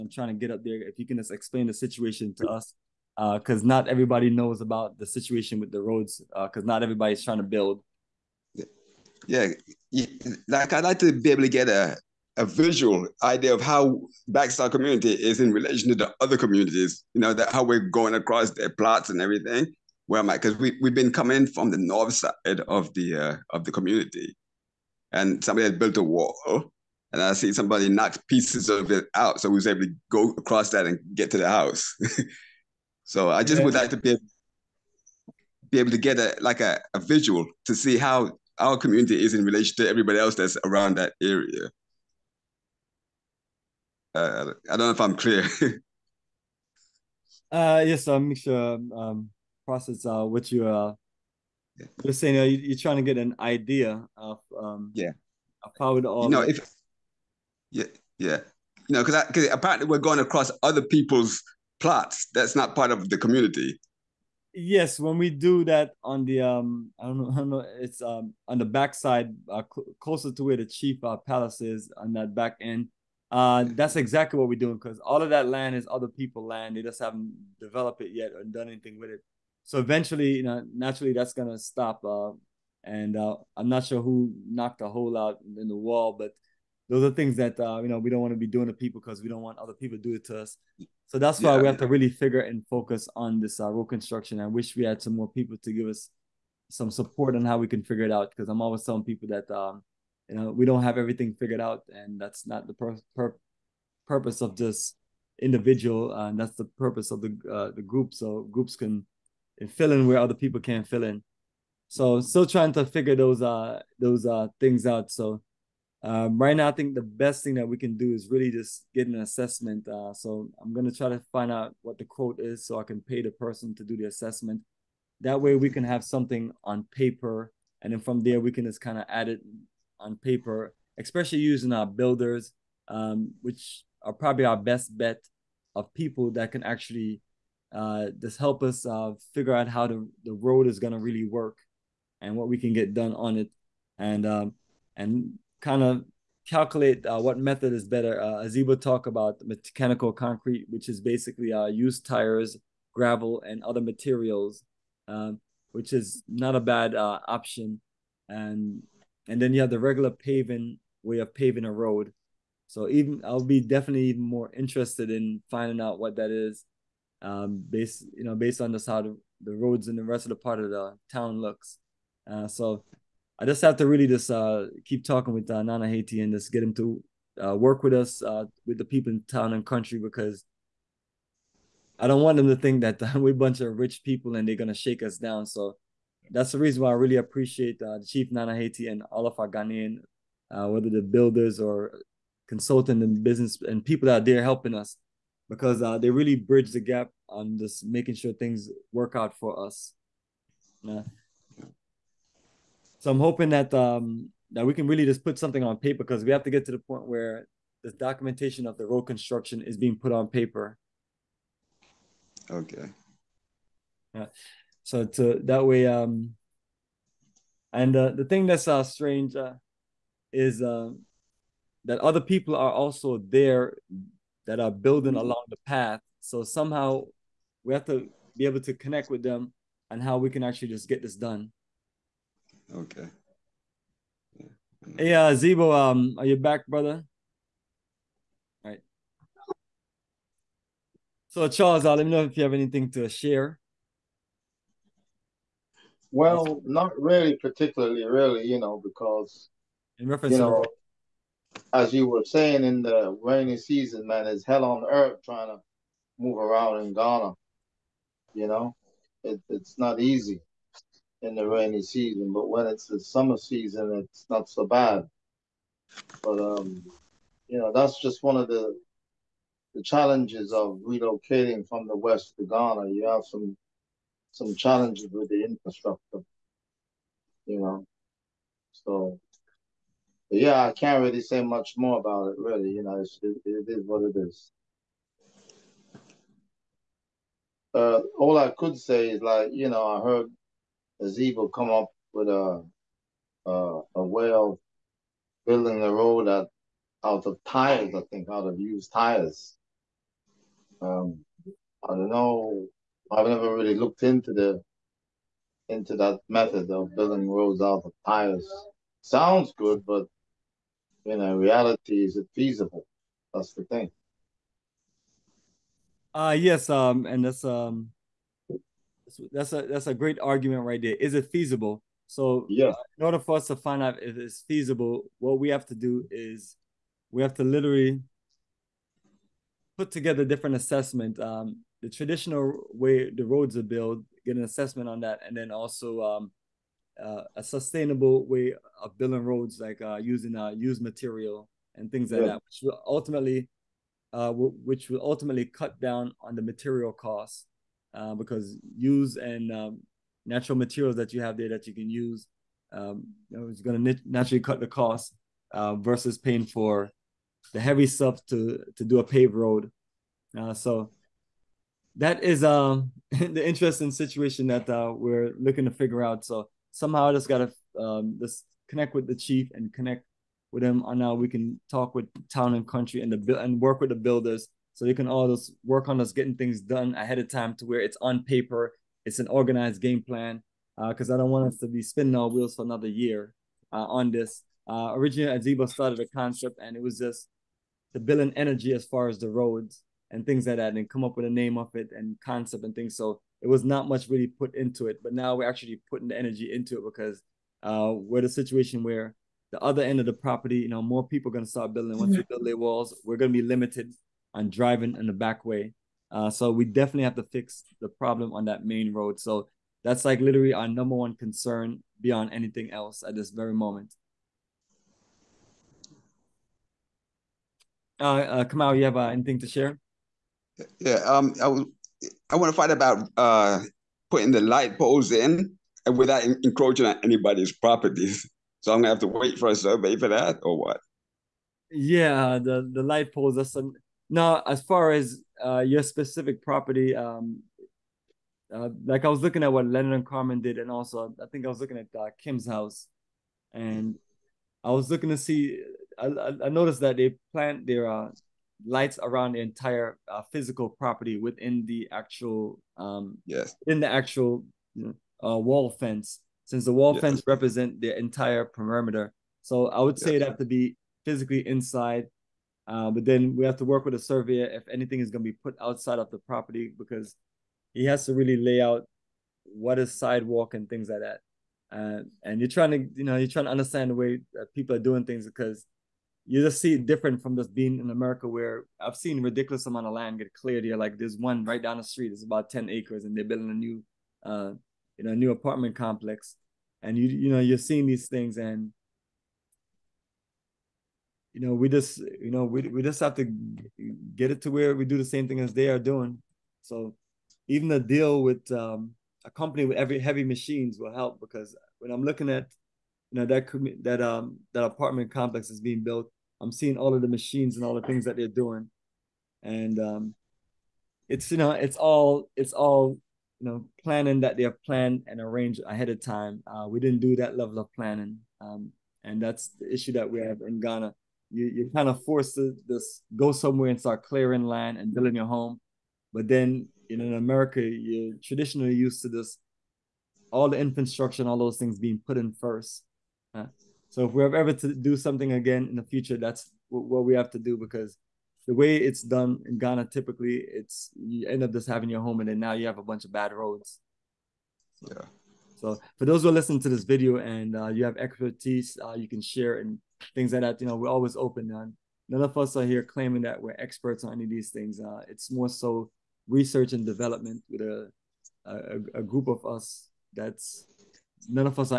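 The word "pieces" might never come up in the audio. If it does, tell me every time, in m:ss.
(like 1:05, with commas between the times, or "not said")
0:28.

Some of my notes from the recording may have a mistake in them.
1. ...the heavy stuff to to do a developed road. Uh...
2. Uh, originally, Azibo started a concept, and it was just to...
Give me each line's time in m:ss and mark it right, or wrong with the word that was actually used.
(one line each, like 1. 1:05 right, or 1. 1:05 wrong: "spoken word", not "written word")
1. 5:57 wrong: "paved", not "developed"
2. 6:24 right.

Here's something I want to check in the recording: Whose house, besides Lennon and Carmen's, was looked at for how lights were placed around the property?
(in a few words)
Kim's.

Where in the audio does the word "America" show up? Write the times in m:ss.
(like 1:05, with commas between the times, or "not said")
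7:57, 8:47.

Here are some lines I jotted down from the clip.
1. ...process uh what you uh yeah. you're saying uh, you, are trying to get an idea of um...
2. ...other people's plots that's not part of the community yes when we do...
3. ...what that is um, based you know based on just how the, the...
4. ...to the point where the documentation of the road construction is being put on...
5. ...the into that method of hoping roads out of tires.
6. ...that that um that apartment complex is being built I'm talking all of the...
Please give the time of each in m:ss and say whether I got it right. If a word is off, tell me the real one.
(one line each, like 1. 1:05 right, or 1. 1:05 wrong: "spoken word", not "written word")
1. 0:49 right
2. 1:00 right
3. 2:45 right
4. 3:26 right
5. 5:04 wrong: "building", not "hoping"
6. 8:23 wrong: "seeing", not "talking".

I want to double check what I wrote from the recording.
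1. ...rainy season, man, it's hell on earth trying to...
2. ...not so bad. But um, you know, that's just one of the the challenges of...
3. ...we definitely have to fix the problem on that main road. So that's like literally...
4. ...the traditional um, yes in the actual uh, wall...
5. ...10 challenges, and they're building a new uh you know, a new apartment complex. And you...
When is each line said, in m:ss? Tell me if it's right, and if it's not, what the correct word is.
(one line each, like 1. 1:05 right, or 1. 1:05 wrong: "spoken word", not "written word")
1. 4:13 right
2. 4:24 right
3. 6:46 right
4. 7:31 wrong: "actual", not "traditional"
5. 8:02 wrong: "acres", not "challenges".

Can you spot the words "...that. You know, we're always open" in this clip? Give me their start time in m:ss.
9:10.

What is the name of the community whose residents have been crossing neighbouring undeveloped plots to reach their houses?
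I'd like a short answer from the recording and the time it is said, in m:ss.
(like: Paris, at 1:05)
Black Star, at 0:14.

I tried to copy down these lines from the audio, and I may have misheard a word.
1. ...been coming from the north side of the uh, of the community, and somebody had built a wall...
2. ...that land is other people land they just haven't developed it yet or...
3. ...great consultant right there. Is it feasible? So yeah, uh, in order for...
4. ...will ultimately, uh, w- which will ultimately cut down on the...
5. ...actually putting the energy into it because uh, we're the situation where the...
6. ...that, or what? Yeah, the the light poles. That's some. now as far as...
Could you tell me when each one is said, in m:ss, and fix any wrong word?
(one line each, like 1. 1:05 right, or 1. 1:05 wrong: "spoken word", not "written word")
1. 0:20 right
2. 1:15 right
3. 5:19 wrong: "argument", not "consultant"
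4. 5:42 right
5. 6:35 right
6. 7:10 right.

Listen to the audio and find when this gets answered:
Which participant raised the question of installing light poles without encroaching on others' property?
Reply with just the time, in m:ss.
6:58.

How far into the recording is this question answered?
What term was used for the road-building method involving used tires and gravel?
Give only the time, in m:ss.
2:29.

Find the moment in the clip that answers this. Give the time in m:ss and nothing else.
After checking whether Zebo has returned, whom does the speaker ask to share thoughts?
4:01.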